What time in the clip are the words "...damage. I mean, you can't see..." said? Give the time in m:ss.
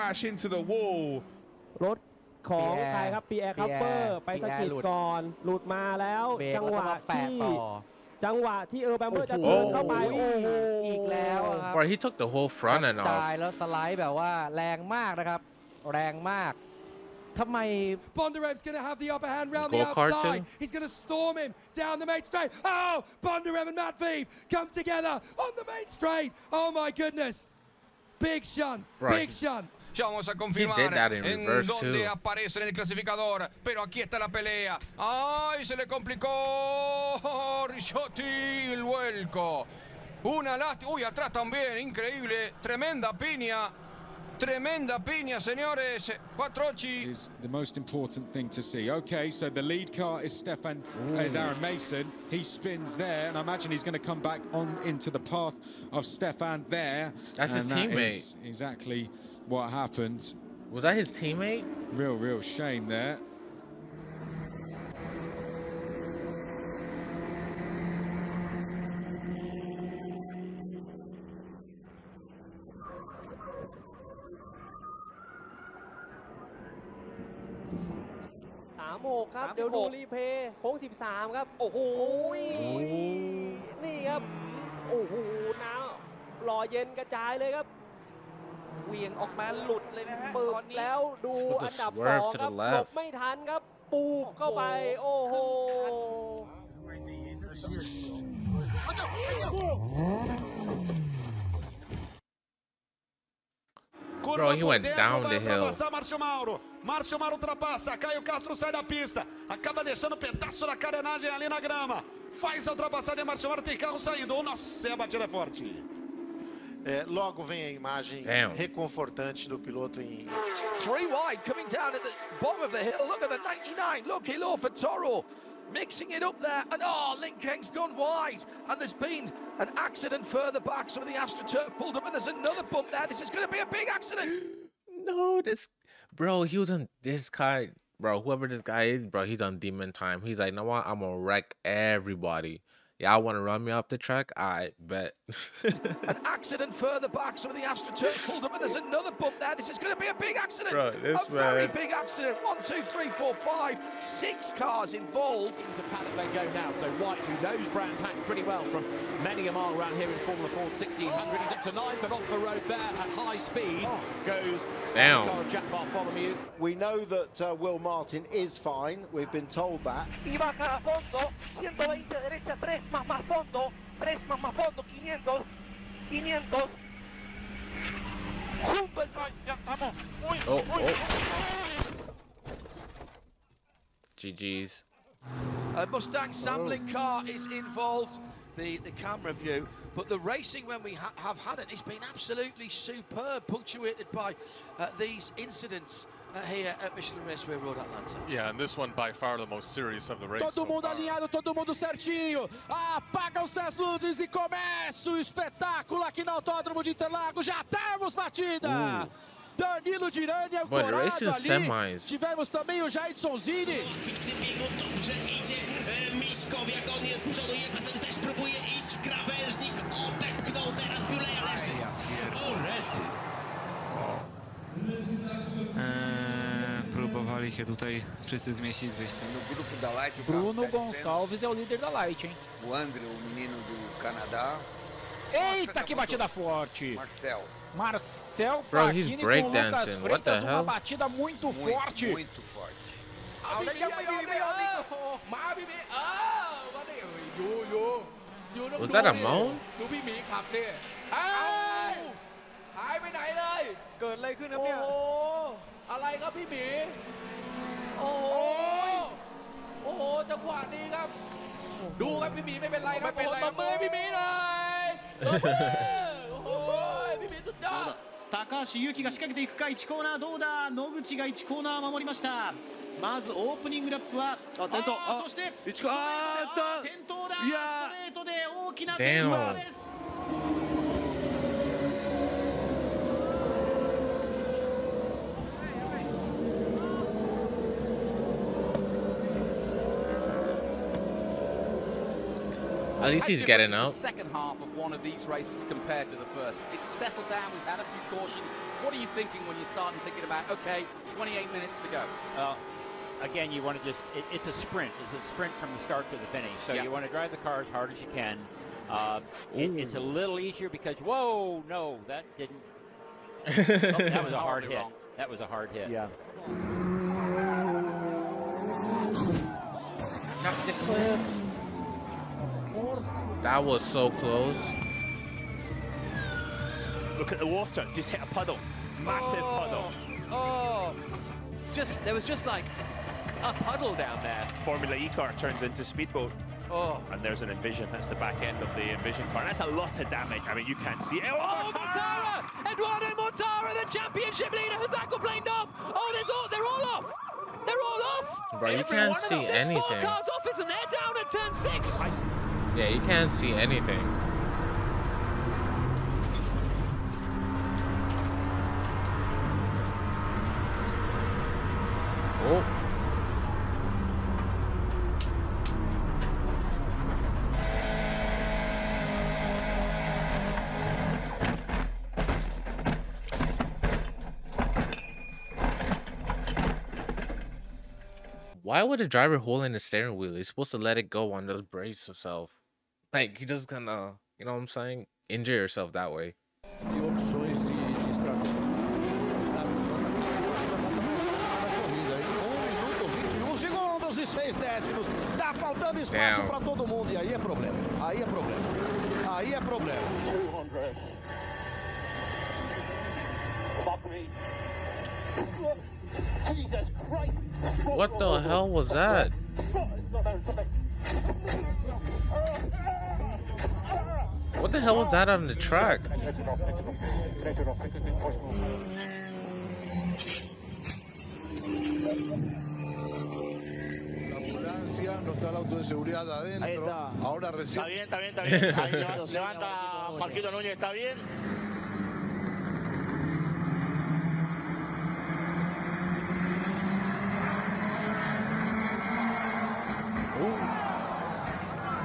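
5:40.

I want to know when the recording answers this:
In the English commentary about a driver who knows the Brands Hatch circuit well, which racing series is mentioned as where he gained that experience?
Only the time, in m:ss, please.
2:40.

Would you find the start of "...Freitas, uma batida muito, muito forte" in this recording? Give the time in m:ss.
3:59.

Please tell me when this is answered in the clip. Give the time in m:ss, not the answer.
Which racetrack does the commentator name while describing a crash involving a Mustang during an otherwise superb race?
3:16.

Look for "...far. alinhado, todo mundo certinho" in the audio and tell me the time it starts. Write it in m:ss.
3:20.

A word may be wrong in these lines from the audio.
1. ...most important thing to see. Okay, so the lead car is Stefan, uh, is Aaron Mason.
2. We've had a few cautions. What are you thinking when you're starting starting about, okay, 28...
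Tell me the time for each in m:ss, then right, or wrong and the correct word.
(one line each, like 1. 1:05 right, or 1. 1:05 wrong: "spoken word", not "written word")
1. 0:47 right
2. 4:57 wrong: "thinking", not "starting".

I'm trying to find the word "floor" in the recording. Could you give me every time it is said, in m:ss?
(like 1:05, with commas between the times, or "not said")
not said.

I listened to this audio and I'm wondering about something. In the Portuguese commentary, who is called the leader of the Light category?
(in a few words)
Bruno Gonçalves.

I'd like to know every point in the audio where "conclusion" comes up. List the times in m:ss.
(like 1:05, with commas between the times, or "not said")
not said.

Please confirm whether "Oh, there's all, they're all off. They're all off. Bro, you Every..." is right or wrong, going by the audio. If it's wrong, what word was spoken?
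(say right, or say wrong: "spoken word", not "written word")
right.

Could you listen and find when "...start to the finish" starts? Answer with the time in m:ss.
5:05.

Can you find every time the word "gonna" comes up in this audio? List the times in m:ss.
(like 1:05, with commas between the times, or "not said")
2:20, 6:23.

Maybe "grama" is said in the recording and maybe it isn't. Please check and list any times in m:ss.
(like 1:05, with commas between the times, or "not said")
1:51.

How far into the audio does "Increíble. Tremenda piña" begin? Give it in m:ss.
0:41.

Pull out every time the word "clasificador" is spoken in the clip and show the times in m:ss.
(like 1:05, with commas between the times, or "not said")
0:32.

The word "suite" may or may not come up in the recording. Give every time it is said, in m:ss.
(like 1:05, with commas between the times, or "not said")
not said.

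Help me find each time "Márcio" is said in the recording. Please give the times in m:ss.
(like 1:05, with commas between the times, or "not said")
1:46, 1:53.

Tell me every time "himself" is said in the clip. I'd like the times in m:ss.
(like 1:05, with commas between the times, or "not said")
6:22.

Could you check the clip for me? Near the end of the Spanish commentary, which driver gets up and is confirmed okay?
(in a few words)
Marquito Núñez.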